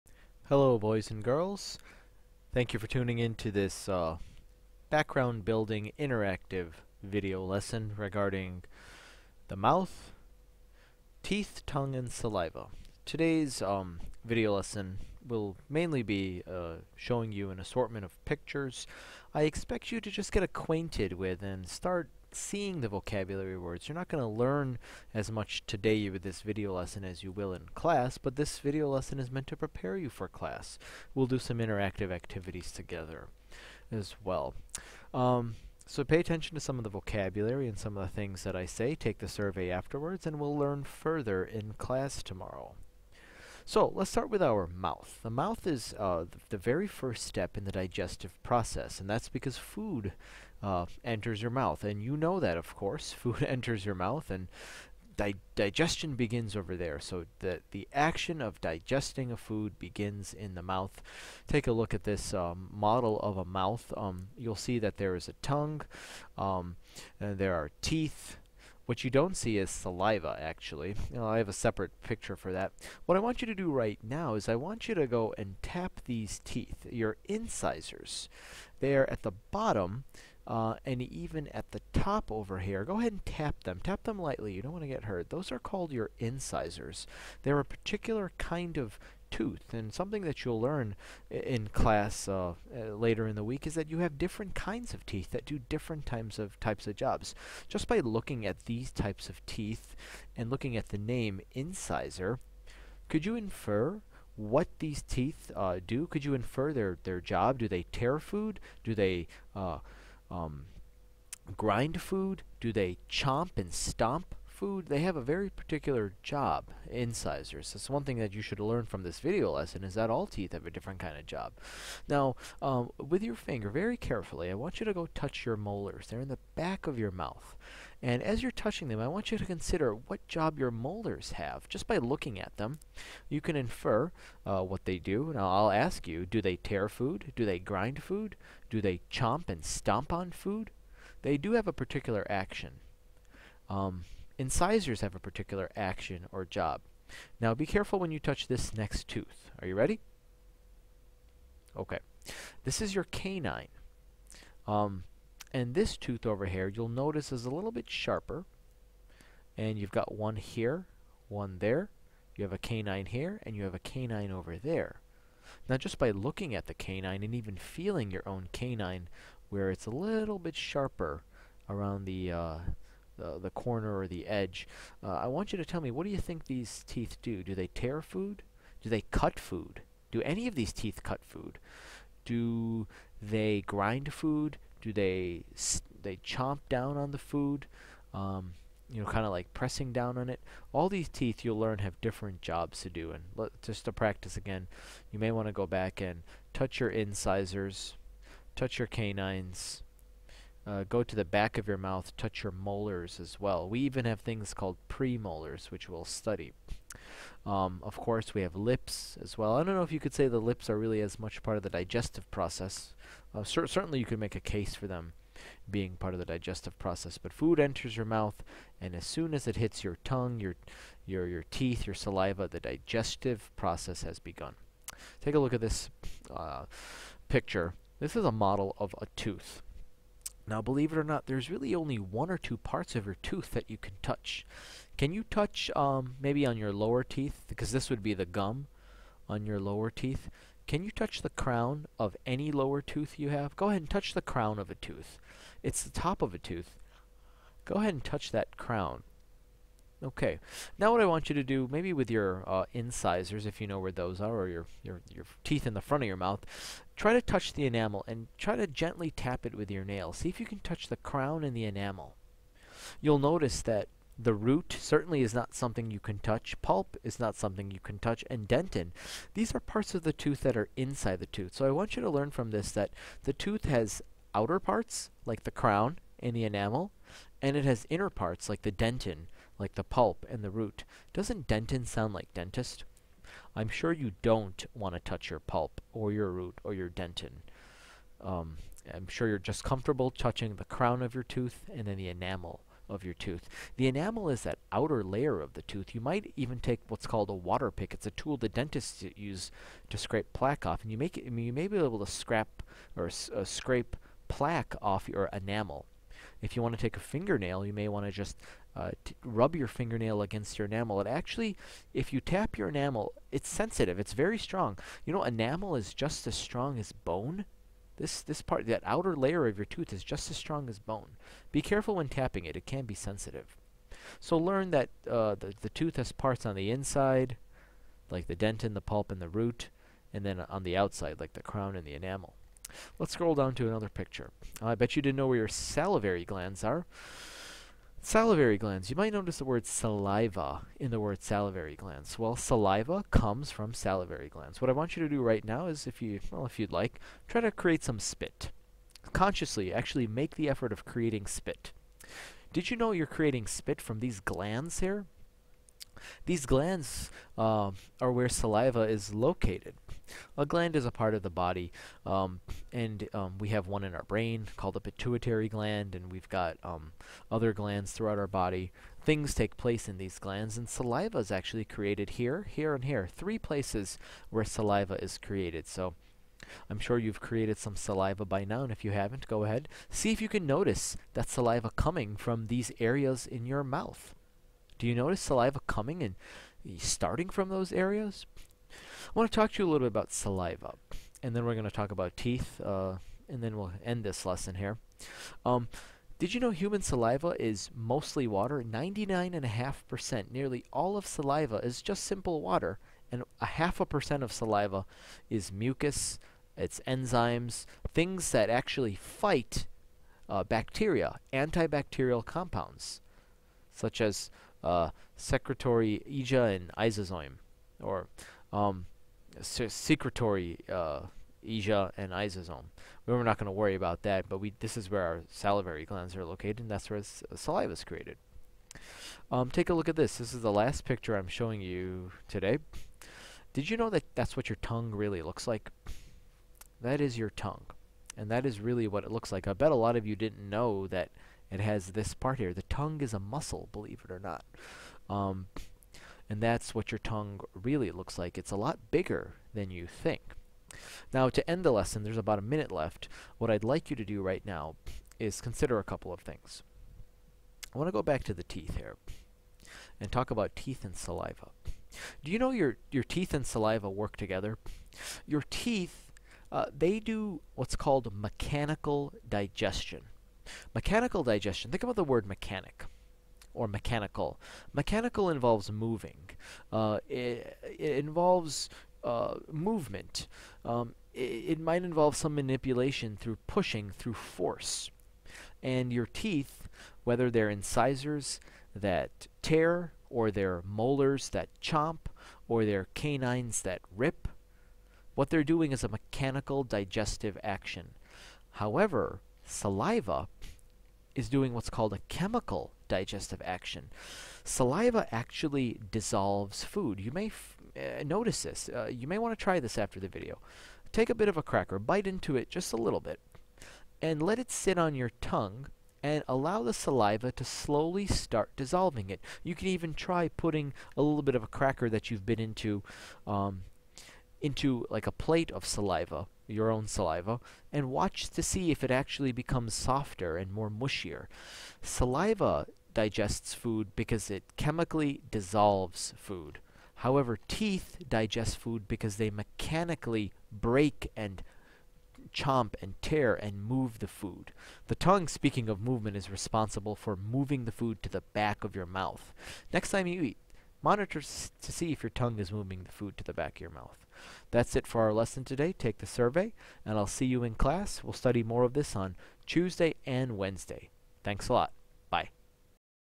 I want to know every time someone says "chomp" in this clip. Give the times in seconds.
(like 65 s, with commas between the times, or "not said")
113 s, 139 s, 186 s, 491 s, 542 s.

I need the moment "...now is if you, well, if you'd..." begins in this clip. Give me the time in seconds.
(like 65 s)
345 s.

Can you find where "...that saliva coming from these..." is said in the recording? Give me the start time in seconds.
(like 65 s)
381 s.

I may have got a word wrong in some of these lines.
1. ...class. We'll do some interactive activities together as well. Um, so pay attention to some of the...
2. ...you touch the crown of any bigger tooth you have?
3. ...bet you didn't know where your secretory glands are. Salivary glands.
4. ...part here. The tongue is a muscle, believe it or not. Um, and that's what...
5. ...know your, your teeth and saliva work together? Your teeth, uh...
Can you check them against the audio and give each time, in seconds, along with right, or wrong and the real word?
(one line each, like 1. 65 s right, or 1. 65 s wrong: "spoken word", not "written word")
1. 30 s right
2. 240 s wrong: "lower", not "bigger"
3. 334 s wrong: "salivary", not "secretory"
4. 442 s right
5. 462 s right.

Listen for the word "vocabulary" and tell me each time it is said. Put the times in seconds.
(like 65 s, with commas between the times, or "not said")
22 s, 36 s.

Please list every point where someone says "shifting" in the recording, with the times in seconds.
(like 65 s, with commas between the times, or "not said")
not said.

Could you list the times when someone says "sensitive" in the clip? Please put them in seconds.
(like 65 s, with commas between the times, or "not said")
313 s, 322 s.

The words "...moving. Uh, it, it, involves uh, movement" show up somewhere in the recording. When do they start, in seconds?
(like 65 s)
475 s.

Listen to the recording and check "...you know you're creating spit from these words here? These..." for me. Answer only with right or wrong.
wrong.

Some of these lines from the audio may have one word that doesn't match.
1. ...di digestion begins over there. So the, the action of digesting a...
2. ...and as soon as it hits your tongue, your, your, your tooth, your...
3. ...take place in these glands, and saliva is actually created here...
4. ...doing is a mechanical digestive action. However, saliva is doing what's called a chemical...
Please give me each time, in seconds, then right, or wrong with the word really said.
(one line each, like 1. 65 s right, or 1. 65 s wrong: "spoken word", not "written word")
1. 55 s right
2. 218 s wrong: "teeth", not "tooth"
3. 369 s right
4. 495 s right.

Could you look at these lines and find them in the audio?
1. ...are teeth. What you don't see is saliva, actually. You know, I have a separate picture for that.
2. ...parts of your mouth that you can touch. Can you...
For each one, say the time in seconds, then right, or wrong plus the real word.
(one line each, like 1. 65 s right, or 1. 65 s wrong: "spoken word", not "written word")
1. 67 s right
2. 232 s wrong: "tooth", not "mouth".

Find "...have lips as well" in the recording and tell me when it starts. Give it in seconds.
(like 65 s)
208 s.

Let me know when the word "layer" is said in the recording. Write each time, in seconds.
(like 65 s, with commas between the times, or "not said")
295 s, 319 s.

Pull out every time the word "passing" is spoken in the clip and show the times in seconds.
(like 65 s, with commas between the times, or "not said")
not said.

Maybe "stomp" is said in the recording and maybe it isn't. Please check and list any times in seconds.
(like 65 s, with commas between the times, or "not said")
113 s, 139 s.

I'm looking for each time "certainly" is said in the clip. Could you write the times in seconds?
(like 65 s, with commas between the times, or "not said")
213 s, 264 s.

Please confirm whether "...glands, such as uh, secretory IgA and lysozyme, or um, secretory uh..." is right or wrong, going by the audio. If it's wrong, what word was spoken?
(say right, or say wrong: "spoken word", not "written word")
wrong: "compounds", not "glands".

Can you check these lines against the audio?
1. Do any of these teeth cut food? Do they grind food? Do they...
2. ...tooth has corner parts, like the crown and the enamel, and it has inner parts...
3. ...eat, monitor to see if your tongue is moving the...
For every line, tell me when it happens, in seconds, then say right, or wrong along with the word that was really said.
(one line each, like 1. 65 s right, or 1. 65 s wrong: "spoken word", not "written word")
1. 180 s right
2. 273 s wrong: "outer", not "corner"
3. 550 s right.